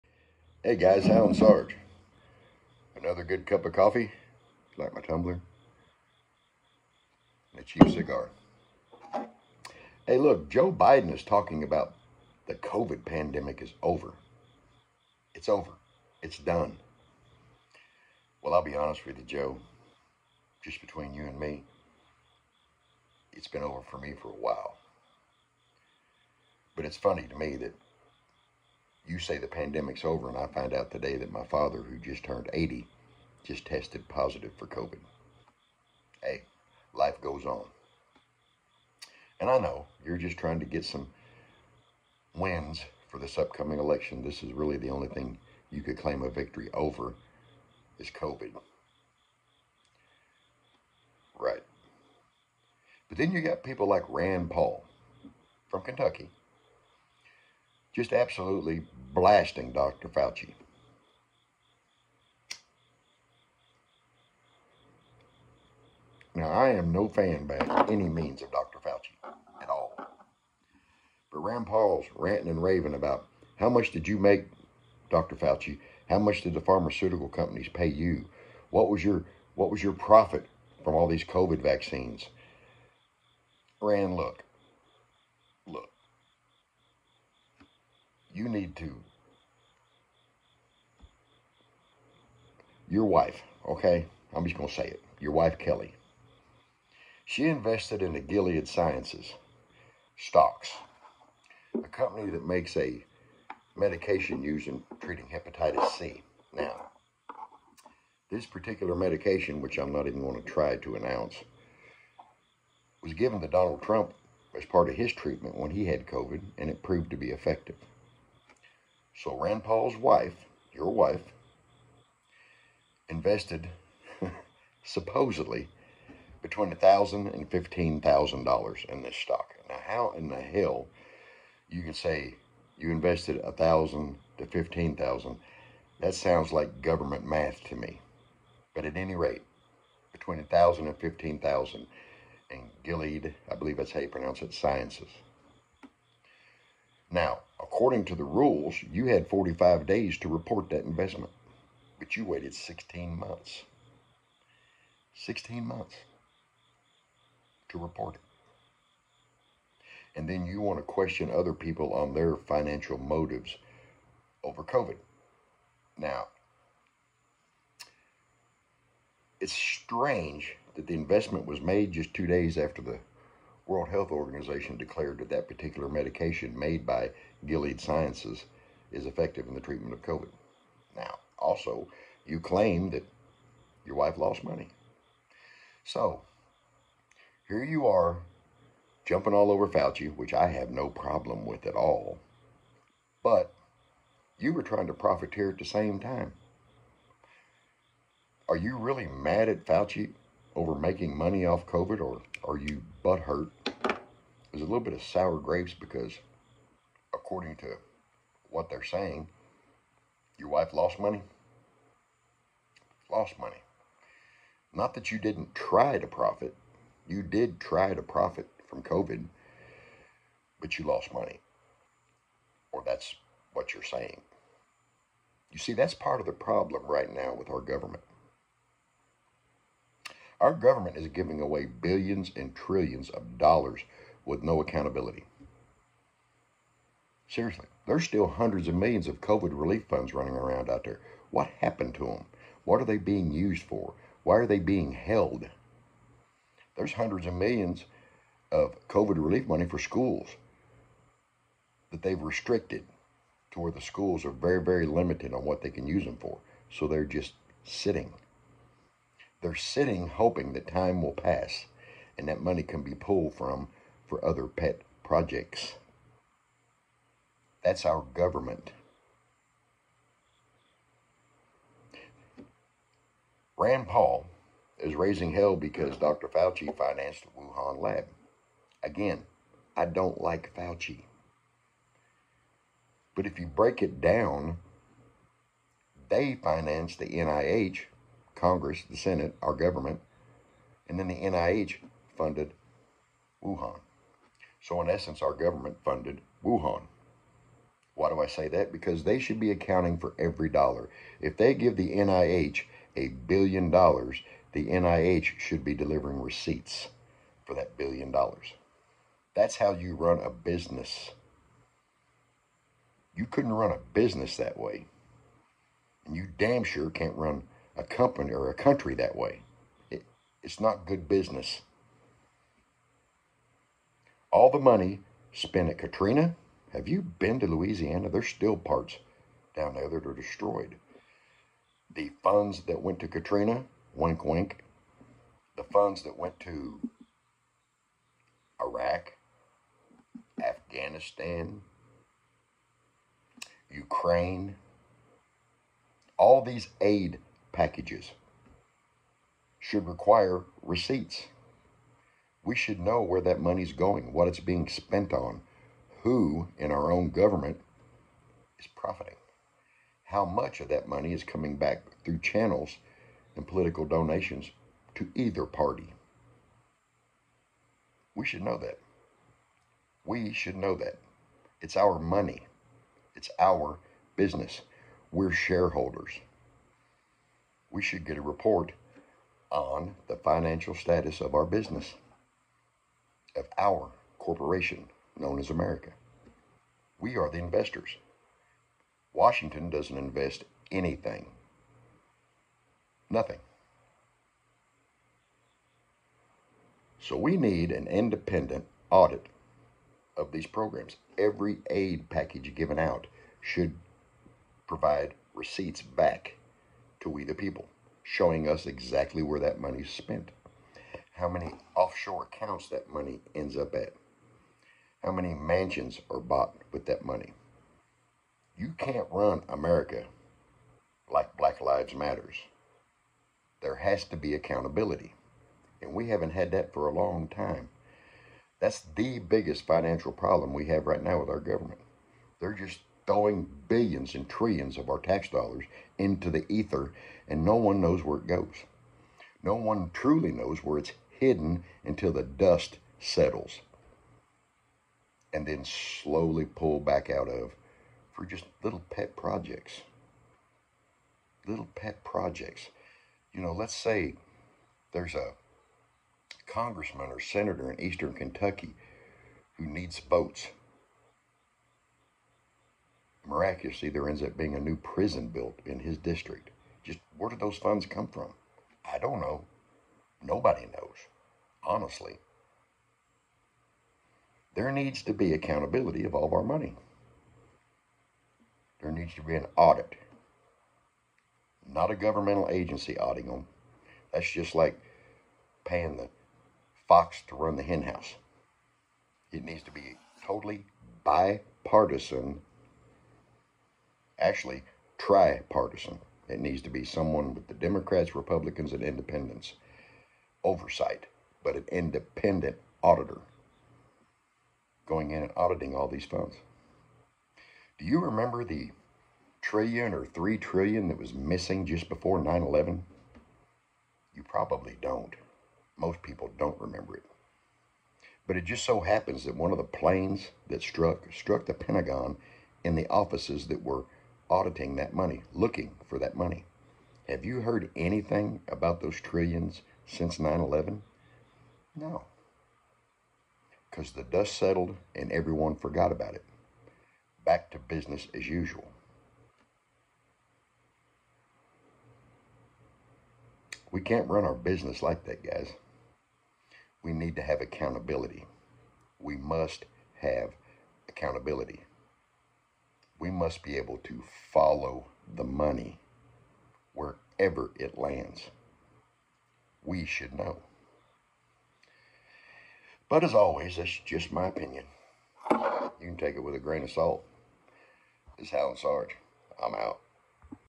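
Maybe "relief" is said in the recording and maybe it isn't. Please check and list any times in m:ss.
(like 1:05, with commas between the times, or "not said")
3:59, 4:09.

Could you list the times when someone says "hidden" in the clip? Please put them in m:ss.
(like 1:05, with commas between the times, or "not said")
7:21.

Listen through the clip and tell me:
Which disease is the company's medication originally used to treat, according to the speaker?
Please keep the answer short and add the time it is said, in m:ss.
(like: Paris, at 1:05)
hepatitis C, at 1:45.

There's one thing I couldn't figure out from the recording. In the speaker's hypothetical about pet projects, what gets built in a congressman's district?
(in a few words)
a new prison.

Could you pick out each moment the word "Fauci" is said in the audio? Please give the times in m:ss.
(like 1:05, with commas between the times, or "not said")
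1:00, 1:08, 1:15, 3:09, 3:19, 4:36, 4:40.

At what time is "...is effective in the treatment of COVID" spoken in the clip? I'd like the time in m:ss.
2:58.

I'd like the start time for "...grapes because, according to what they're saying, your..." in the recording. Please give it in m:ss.
3:25.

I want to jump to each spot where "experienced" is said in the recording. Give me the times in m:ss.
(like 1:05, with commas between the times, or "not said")
not said.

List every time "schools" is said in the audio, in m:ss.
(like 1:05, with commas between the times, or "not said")
4:09, 4:13.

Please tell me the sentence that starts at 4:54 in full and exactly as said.
So, in essence, our government funded Wuhan.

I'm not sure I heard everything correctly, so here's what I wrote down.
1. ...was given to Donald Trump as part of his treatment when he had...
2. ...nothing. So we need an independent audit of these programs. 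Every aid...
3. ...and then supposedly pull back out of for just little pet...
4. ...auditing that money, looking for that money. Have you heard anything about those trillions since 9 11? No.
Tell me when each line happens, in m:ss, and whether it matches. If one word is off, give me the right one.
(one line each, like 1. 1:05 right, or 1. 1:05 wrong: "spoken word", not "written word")
1. 1:53 right
2. 6:33 right
3. 7:25 wrong: "slowly", not "supposedly"
4. 8:44 right.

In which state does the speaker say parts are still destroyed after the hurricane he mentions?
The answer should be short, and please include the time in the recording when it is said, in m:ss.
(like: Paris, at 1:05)
Louisiana, at 5:27.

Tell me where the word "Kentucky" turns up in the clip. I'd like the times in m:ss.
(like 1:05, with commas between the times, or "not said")
0:55, 7:38.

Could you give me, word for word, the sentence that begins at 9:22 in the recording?
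But as always, that's just my opinion.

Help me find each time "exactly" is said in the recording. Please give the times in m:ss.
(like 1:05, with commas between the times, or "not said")
6:48.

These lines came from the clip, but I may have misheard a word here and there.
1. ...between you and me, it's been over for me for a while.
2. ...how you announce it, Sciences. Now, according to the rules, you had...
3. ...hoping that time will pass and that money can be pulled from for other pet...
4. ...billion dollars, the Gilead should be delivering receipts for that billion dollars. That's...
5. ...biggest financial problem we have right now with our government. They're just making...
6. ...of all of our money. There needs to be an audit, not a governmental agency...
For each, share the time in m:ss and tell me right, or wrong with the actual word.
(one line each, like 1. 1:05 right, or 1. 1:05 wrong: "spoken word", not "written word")
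1. 0:20 right
2. 2:23 wrong: "pronounce", not "announce"
3. 4:20 right
4. 5:03 wrong: "NIH", not "Gilead"
5. 7:09 wrong: "throwing", not "making"
6. 7:56 right.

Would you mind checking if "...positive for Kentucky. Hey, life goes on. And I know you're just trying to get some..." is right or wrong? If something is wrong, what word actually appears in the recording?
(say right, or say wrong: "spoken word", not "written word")
wrong: "COVID", not "Kentucky".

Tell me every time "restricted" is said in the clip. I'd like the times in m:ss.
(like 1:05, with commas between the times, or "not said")
4:12.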